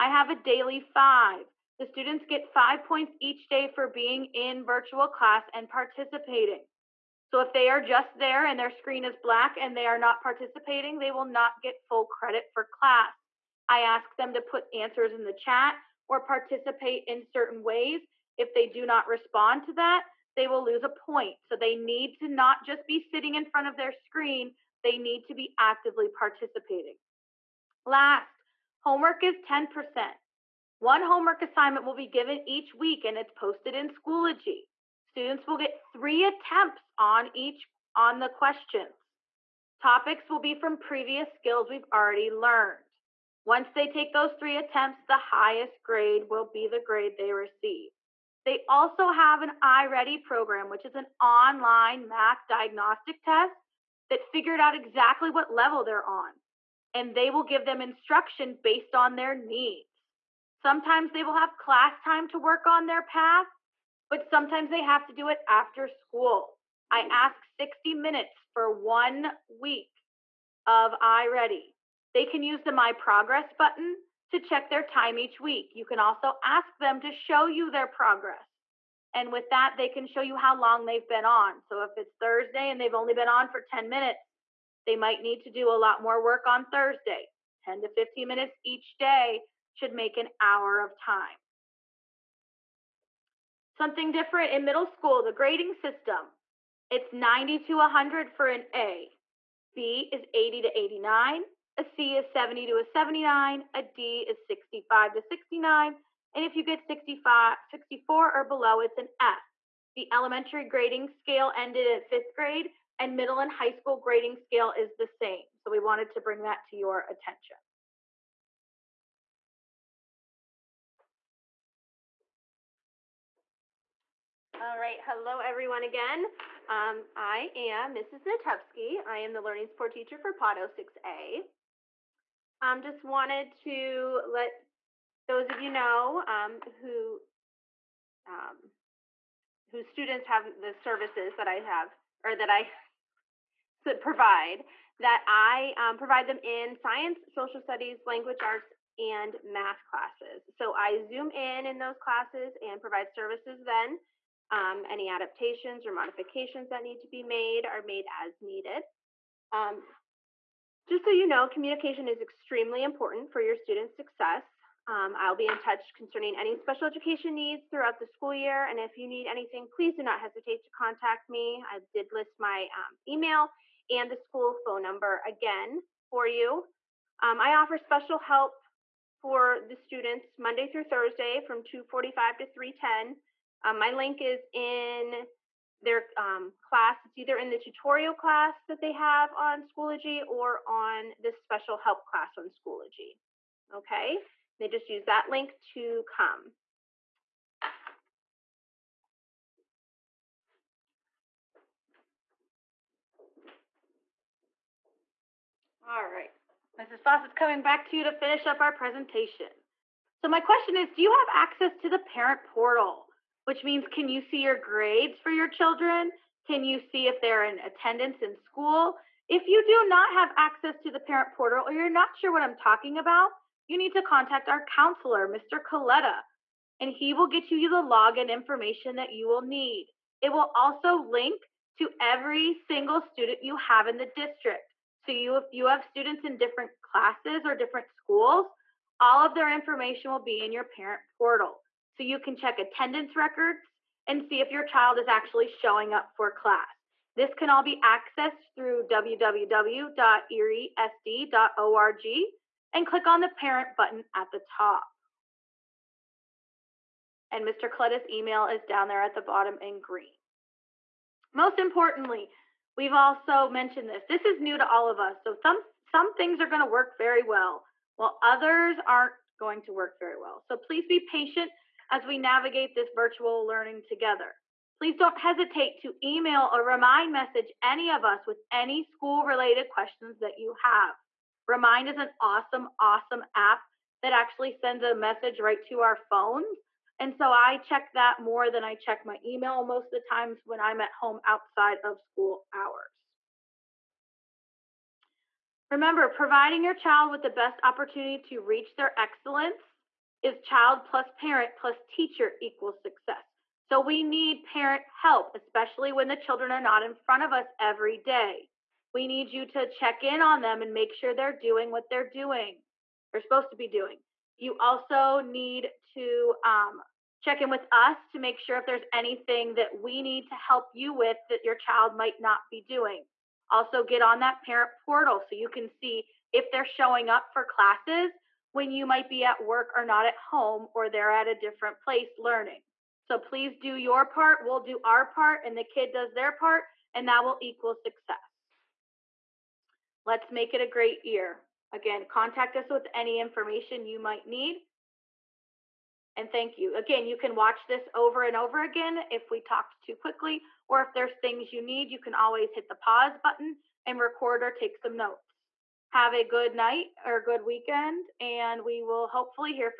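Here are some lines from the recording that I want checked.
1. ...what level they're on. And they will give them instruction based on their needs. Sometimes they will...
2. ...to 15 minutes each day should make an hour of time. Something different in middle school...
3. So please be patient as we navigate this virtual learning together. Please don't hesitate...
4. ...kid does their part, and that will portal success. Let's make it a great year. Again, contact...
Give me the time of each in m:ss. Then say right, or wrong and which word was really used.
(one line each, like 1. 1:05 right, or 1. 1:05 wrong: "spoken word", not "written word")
1. 0:55 right
2. 1:27 right
3. 4:30 right
4. 5:35 wrong: "equal", not "portal".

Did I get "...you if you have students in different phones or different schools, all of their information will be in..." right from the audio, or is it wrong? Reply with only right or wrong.
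wrong.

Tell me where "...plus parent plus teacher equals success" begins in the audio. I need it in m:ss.
5:00.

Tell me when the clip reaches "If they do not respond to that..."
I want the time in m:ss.
0:18.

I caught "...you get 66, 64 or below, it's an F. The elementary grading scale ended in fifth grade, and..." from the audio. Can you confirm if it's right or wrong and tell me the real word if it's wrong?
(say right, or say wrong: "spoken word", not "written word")
wrong: "65", not "66".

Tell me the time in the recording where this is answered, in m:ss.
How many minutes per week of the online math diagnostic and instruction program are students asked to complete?
1:07.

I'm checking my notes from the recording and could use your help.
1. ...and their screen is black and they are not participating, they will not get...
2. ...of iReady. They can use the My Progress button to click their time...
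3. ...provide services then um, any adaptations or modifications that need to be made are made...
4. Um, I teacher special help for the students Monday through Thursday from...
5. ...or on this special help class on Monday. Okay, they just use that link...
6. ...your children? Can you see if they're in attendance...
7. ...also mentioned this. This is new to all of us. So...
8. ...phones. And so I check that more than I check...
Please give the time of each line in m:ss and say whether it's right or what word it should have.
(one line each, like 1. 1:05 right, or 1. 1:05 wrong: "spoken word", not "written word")
1. 0:08 right
2. 1:10 wrong: "check", not "click"
3. 2:32 right
4. 2:57 wrong: "offer", not "teacher"
5. 3:10 wrong: "Schoology", not "Monday"
6. 3:35 right
7. 4:22 right
8. 4:45 right.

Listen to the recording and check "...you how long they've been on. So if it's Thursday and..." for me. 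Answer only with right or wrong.
right.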